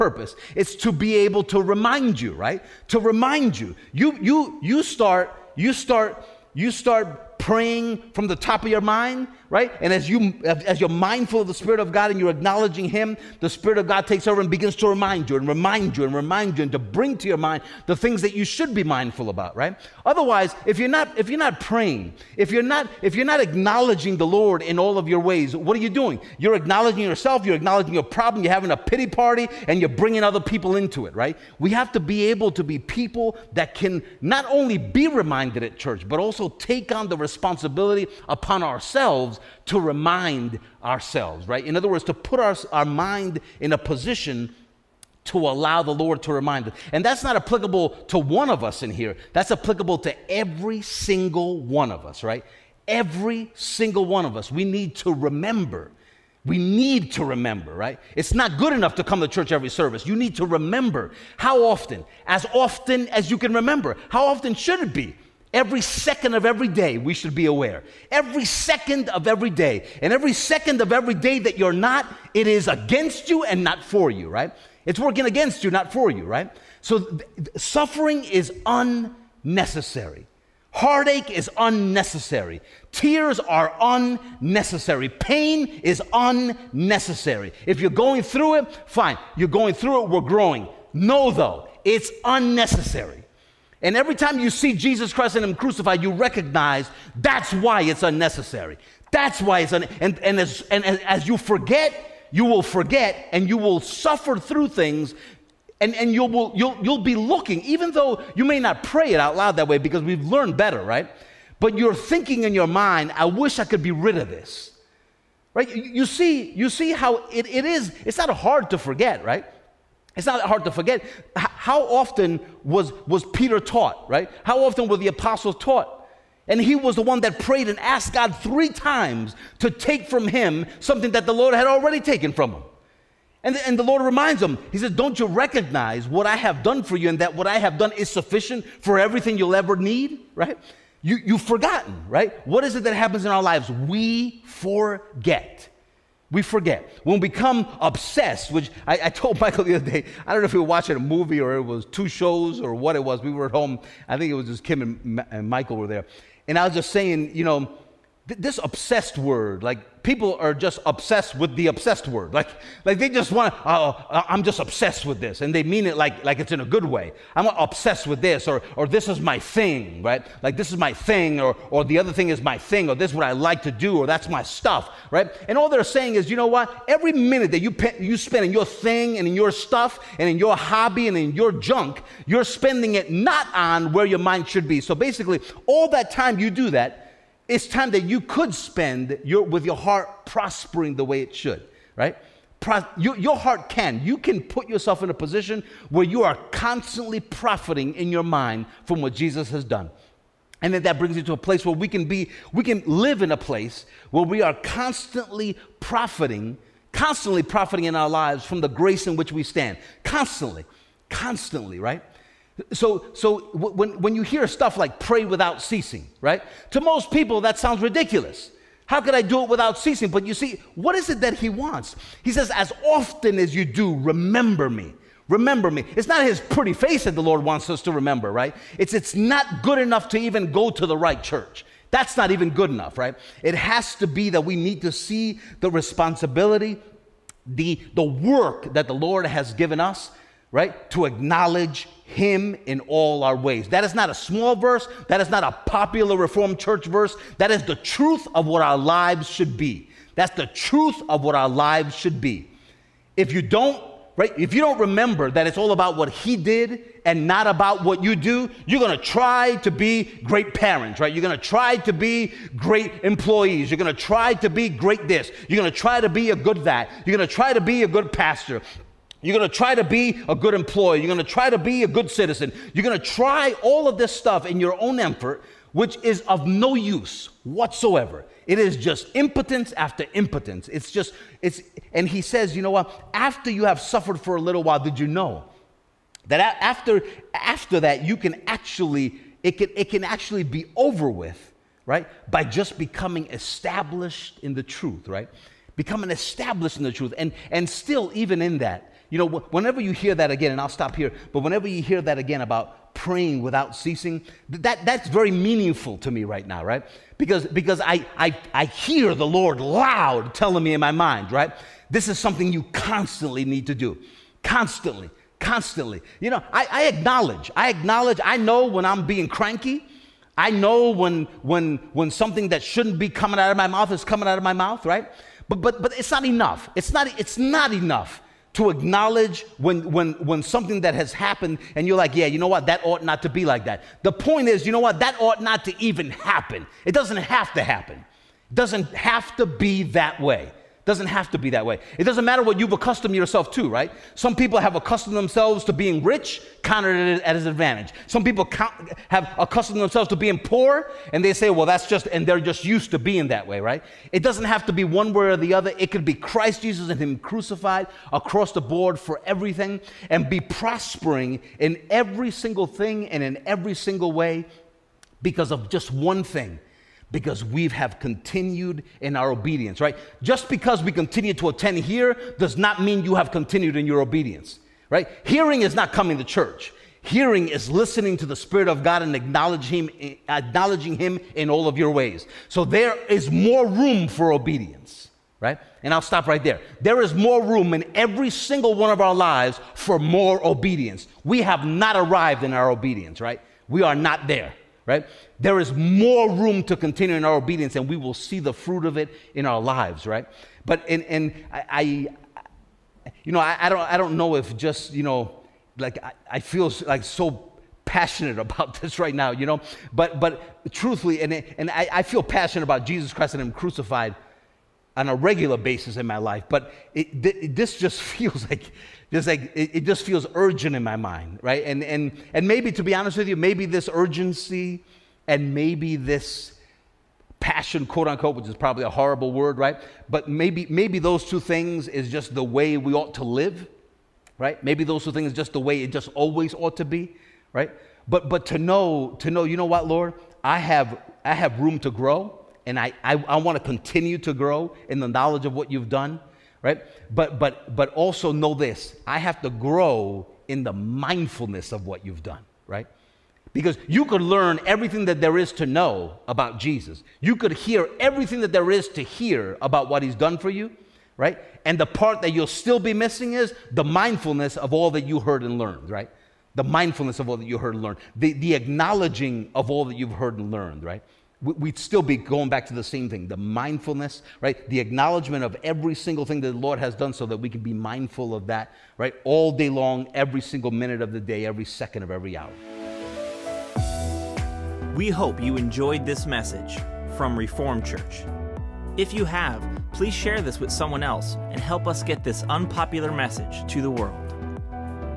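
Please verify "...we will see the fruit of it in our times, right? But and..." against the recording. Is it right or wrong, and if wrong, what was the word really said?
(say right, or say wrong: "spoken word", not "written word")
wrong: "lives", not "times".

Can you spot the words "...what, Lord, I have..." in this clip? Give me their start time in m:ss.
7:19.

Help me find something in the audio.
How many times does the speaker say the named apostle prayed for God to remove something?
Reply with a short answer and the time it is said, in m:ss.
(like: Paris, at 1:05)
3 times, at 2:08.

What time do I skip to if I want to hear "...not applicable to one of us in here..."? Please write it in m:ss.
0:47.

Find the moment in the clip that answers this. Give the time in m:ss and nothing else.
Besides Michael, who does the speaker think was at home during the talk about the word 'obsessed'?
2:34.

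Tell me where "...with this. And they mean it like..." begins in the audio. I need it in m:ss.
2:45.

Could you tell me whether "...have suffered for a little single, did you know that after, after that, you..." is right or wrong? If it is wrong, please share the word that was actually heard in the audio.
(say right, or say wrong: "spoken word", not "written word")
wrong: "while", not "single".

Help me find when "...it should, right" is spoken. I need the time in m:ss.
3:11.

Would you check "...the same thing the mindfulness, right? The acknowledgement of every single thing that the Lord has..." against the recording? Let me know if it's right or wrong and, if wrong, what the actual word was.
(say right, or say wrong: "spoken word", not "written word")
right.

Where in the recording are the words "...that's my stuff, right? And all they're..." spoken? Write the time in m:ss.
2:54.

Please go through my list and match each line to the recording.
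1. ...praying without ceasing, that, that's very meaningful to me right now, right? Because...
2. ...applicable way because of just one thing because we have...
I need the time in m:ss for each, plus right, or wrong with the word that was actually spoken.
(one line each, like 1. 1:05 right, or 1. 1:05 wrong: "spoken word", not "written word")
1. 5:02 right
2. 6:03 wrong: "single", not "applicable".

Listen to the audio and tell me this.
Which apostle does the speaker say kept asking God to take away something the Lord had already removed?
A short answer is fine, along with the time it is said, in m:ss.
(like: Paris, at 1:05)
Peter, at 2:03.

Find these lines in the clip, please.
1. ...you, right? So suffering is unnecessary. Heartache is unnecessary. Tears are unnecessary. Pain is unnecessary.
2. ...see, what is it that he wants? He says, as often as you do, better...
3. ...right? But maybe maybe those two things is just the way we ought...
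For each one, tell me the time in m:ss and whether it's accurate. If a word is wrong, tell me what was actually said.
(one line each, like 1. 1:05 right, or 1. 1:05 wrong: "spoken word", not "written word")
1. 1:16 right
2. 3:40 wrong: "remember", not "better"
3. 7:09 right.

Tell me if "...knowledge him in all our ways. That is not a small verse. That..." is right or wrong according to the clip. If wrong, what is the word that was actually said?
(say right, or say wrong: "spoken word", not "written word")
wrong: "acknowledge", not "knowledge".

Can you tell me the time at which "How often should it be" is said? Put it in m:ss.
1:04.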